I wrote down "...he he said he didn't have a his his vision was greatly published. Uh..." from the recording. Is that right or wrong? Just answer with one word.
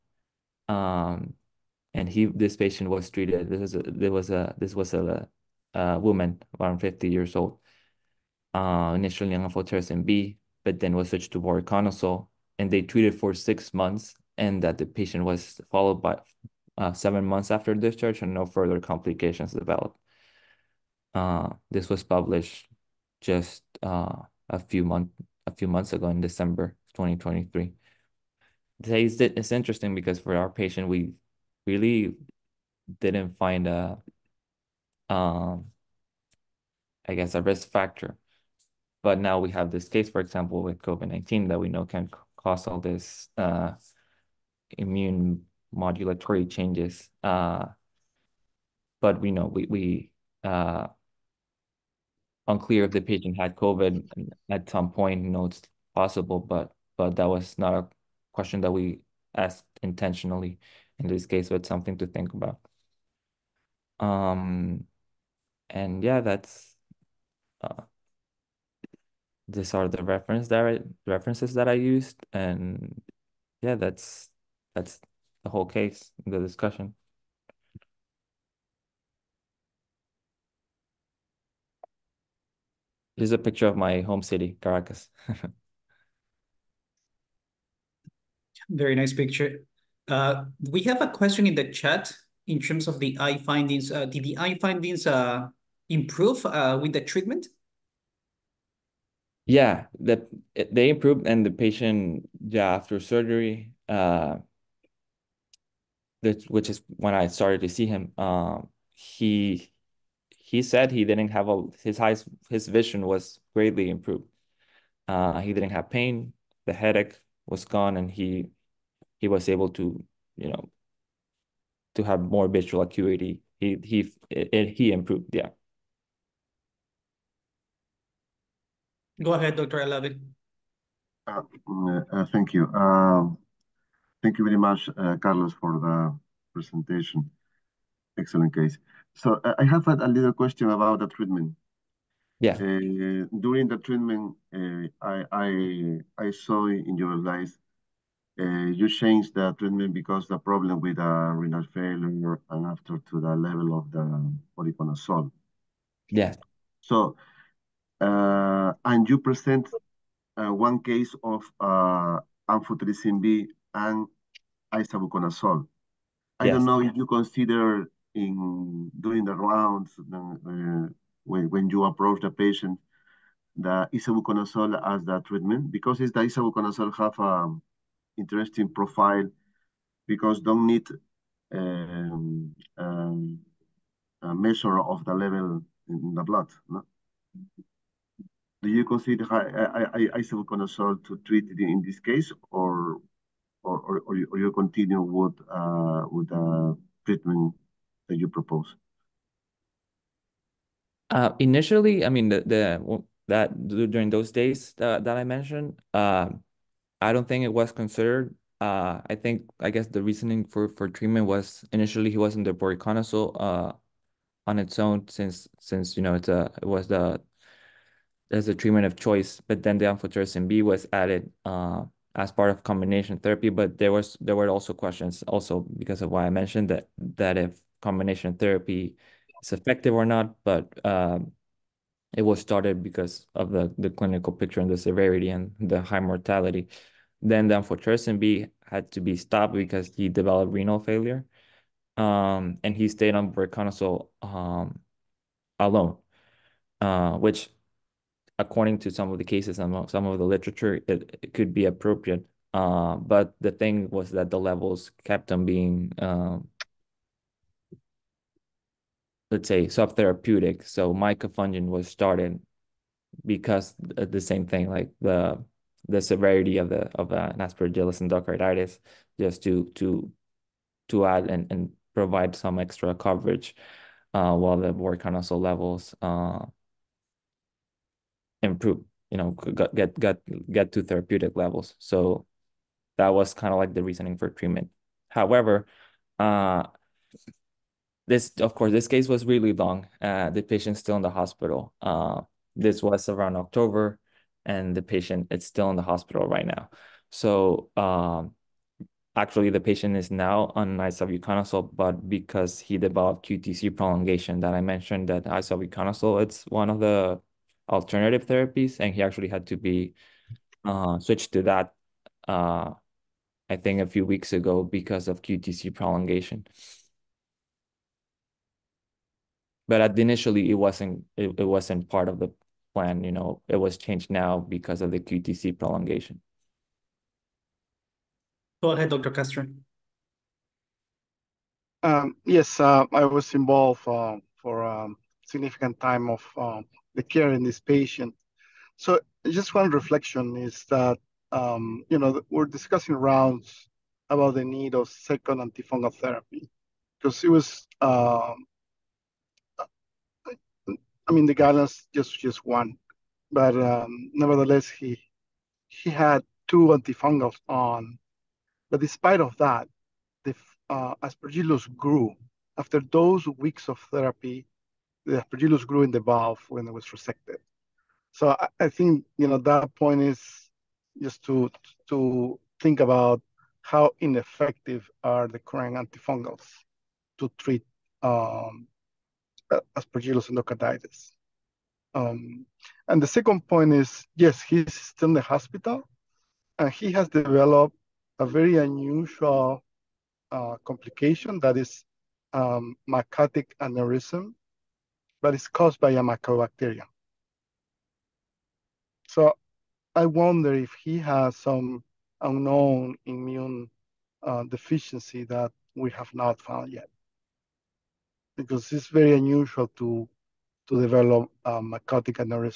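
wrong.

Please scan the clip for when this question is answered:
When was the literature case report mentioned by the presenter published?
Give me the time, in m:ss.
0:26.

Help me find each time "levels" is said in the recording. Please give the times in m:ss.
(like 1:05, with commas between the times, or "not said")
2:33, 3:05, 4:14, 4:35, 4:41.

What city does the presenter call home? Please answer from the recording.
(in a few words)
Caracas.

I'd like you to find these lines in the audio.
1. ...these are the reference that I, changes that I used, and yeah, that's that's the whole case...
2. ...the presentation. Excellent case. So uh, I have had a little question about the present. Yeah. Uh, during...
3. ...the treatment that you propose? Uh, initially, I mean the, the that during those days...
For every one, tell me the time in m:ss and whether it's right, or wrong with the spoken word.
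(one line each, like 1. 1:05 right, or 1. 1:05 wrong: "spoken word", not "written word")
1. 1:09 wrong: "references", not "changes"
2. 2:15 wrong: "treatment", not "present"
3. 3:16 right.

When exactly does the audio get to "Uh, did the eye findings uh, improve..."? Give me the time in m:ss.
1:33.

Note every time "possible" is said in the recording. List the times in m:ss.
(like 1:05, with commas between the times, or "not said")
0:55.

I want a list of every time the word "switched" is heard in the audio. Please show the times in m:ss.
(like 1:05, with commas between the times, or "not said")
0:11, 5:10.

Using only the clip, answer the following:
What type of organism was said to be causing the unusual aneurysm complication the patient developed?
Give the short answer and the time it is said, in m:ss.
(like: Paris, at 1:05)
mycobacteria, at 6:36.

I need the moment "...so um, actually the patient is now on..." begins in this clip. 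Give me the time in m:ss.
4:57.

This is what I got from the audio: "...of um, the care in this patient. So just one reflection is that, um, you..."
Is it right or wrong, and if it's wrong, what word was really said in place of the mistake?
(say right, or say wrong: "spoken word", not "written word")
right.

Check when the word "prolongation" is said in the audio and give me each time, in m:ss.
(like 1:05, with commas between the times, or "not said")
5:03, 5:15, 5:25.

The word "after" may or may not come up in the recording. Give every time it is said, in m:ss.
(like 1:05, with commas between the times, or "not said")
0:17, 1:42, 2:32, 6:02.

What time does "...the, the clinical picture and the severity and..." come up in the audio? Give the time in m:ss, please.
3:53.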